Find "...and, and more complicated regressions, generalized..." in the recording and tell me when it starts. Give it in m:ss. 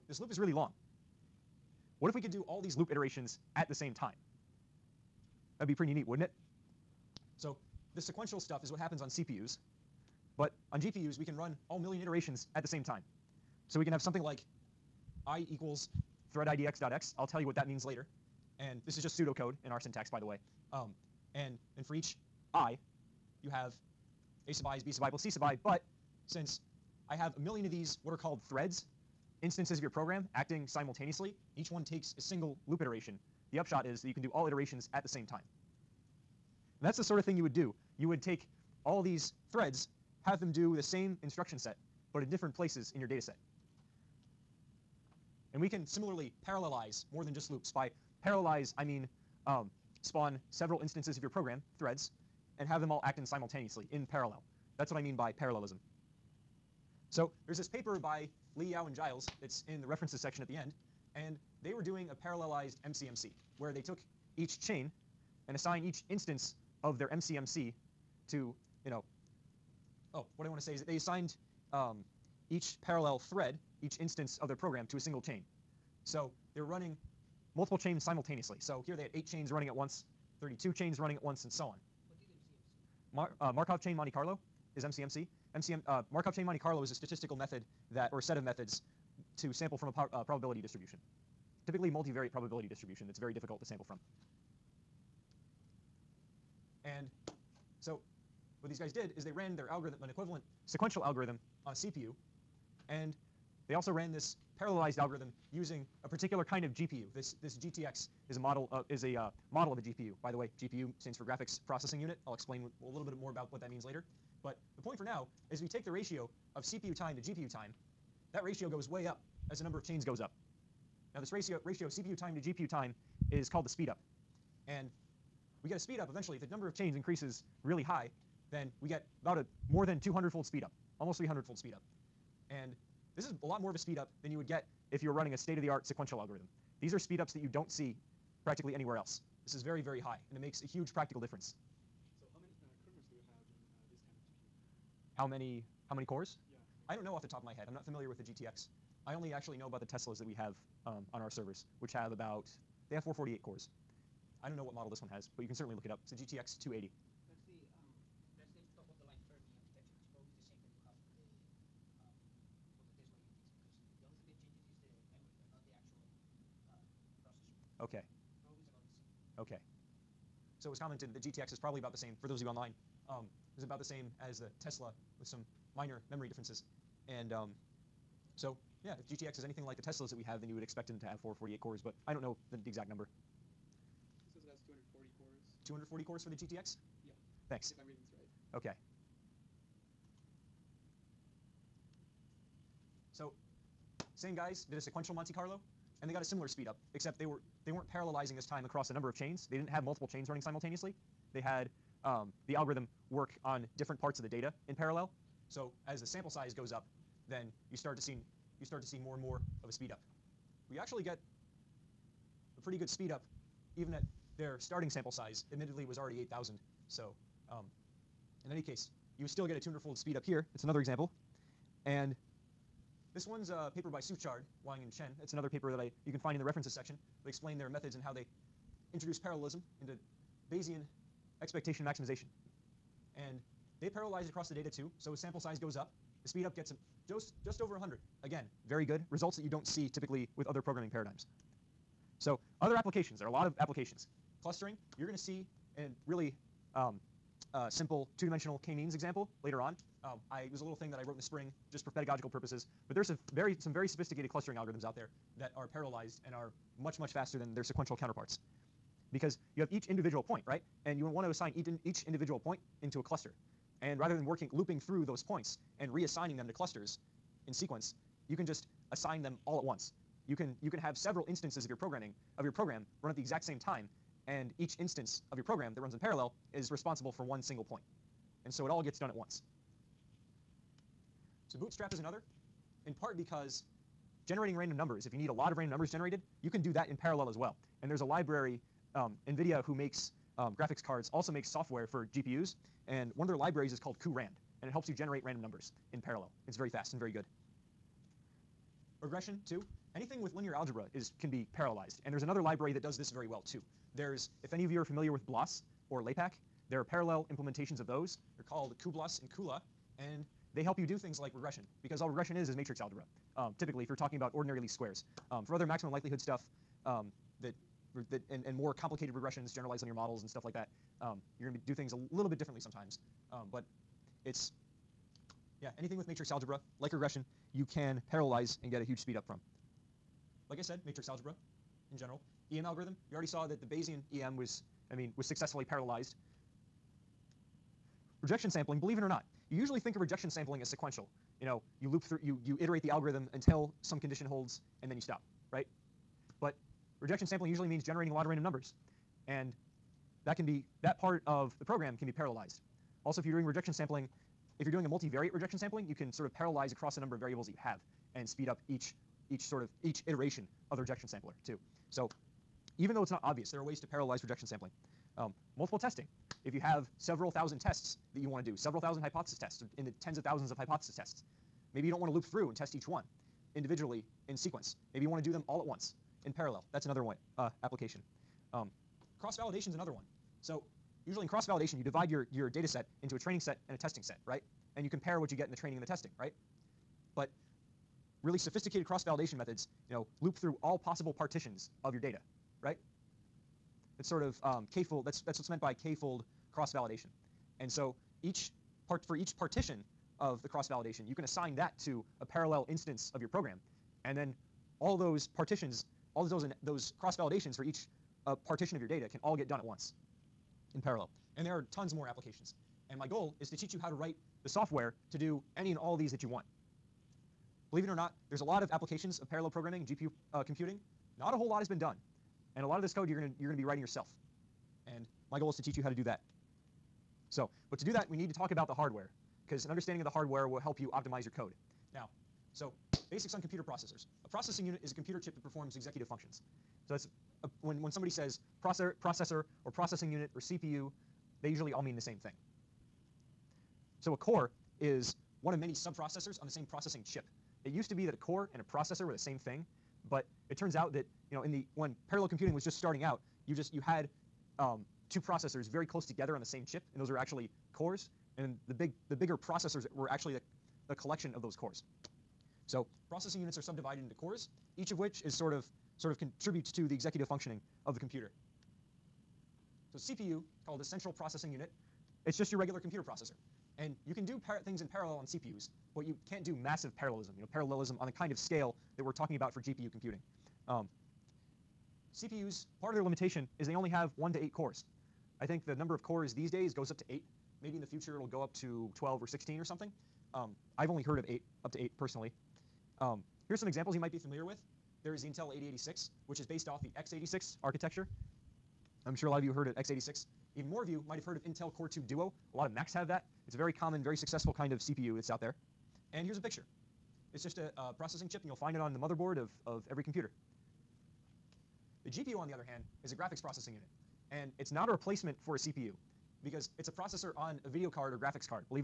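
5:18.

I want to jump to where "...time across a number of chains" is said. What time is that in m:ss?
3:18.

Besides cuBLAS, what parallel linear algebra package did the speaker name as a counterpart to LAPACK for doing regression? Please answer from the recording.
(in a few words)
CULA.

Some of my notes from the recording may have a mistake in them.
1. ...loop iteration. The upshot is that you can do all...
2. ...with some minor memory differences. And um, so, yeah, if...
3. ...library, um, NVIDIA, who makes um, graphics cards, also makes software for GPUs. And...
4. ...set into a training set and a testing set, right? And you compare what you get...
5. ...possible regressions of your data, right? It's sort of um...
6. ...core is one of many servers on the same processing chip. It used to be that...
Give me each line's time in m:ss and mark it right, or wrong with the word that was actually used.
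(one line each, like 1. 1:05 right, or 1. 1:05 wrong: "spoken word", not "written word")
1. 0:32 right
2. 2:55 right
3. 4:48 right
4. 6:22 right
5. 6:30 wrong: "partitions", not "regressions"
6. 7:24 wrong: "subprocessors", not "servers".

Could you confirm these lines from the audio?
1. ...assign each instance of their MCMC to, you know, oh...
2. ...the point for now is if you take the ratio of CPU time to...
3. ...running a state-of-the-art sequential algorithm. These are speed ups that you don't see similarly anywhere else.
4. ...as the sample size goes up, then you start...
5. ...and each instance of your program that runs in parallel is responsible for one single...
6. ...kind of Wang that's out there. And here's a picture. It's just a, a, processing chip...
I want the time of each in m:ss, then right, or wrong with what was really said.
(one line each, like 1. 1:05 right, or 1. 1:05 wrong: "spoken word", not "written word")
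1. 1:05 right
2. 1:54 right
3. 2:15 wrong: "practically", not "similarly"
4. 3:25 right
5. 4:34 right
6. 8:24 wrong: "CPU", not "Wang".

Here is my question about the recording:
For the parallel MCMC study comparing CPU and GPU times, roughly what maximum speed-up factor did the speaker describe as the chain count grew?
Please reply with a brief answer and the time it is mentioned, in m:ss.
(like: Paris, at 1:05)
almost 300-fold, at 2:10.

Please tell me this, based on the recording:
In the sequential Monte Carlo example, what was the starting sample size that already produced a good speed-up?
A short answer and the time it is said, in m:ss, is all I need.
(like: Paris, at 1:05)
8,000, at 3:36.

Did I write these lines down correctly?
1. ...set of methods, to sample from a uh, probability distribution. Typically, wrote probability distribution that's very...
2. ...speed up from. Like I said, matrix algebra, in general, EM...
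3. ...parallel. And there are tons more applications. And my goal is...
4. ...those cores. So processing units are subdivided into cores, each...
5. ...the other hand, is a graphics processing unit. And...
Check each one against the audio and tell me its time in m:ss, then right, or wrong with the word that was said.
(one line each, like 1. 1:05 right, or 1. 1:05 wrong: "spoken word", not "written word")
1. 1:28 wrong: "multivariate", not "wrote"
2. 5:28 right
3. 6:50 right
4. 7:41 right
5. 8:32 right.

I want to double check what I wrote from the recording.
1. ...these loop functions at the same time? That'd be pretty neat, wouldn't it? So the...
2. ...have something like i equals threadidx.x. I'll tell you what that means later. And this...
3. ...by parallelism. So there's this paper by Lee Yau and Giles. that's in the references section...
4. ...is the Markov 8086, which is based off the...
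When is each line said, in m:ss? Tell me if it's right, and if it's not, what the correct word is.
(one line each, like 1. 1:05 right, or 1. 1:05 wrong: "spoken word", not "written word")
1. 0:02 wrong: "iterations", not "functions"
2. 0:13 right
3. 0:55 right
4. 8:15 wrong: "Intel", not "Markov".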